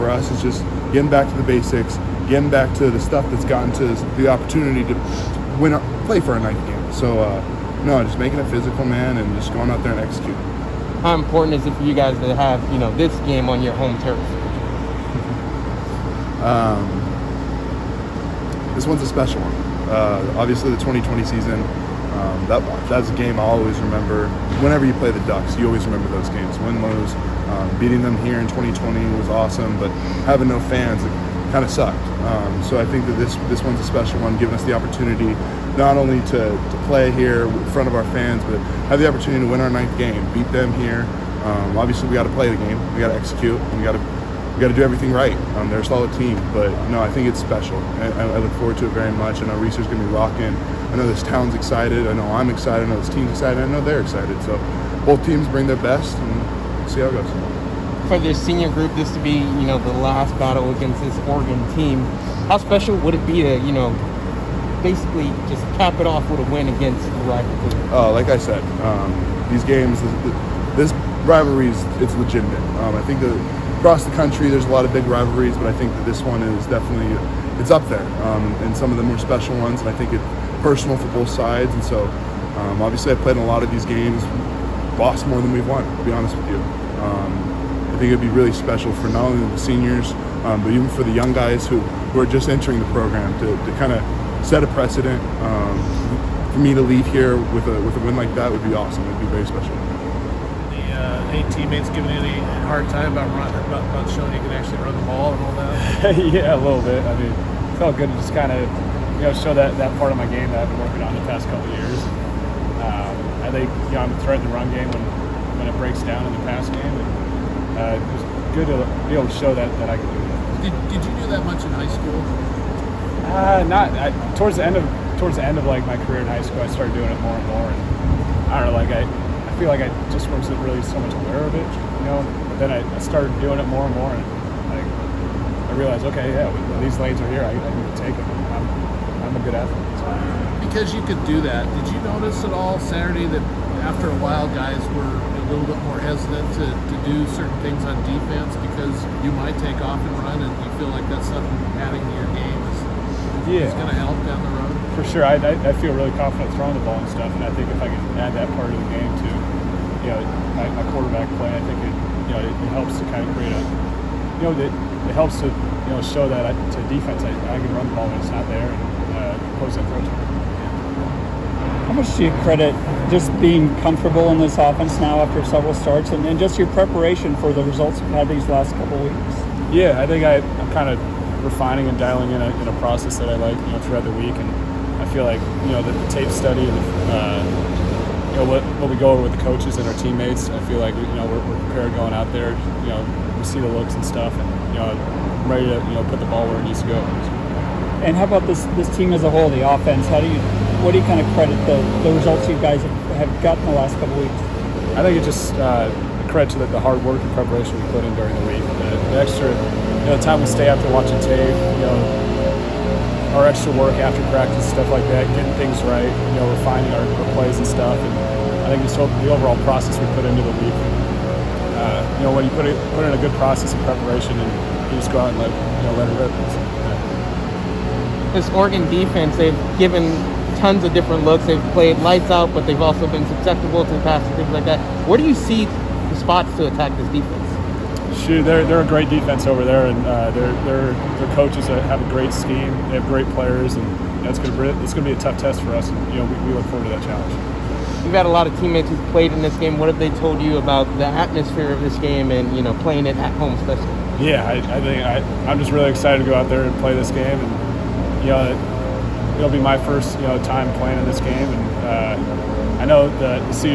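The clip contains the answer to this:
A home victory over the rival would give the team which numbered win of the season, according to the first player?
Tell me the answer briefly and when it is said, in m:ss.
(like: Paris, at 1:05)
ninth, at 0:39.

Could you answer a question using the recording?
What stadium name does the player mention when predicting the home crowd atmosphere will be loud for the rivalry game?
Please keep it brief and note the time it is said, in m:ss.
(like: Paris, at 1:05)
Reser's, at 0:49.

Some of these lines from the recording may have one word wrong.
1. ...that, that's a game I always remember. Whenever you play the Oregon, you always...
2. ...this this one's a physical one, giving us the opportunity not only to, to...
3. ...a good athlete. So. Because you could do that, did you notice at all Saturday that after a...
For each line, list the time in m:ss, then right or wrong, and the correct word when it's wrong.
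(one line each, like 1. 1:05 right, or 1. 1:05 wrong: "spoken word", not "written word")
1. 0:22 wrong: "Ducks", not "Oregon"
2. 0:33 wrong: "special", not "physical"
3. 2:19 right.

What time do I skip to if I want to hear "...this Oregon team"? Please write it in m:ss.
1:01.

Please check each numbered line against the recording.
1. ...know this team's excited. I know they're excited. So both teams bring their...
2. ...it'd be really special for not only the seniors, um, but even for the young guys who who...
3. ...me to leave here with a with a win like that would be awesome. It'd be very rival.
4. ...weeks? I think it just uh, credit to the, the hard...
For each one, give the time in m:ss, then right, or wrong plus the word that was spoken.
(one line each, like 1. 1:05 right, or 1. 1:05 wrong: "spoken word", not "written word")
1. 0:52 right
2. 1:28 right
3. 1:36 wrong: "special", not "rival"
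4. 3:24 right.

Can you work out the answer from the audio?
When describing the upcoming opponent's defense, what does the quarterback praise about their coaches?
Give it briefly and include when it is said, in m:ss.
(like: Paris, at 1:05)
great scheme, at 4:02.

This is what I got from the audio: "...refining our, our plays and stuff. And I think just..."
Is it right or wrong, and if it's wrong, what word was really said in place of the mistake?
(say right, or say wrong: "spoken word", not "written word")
right.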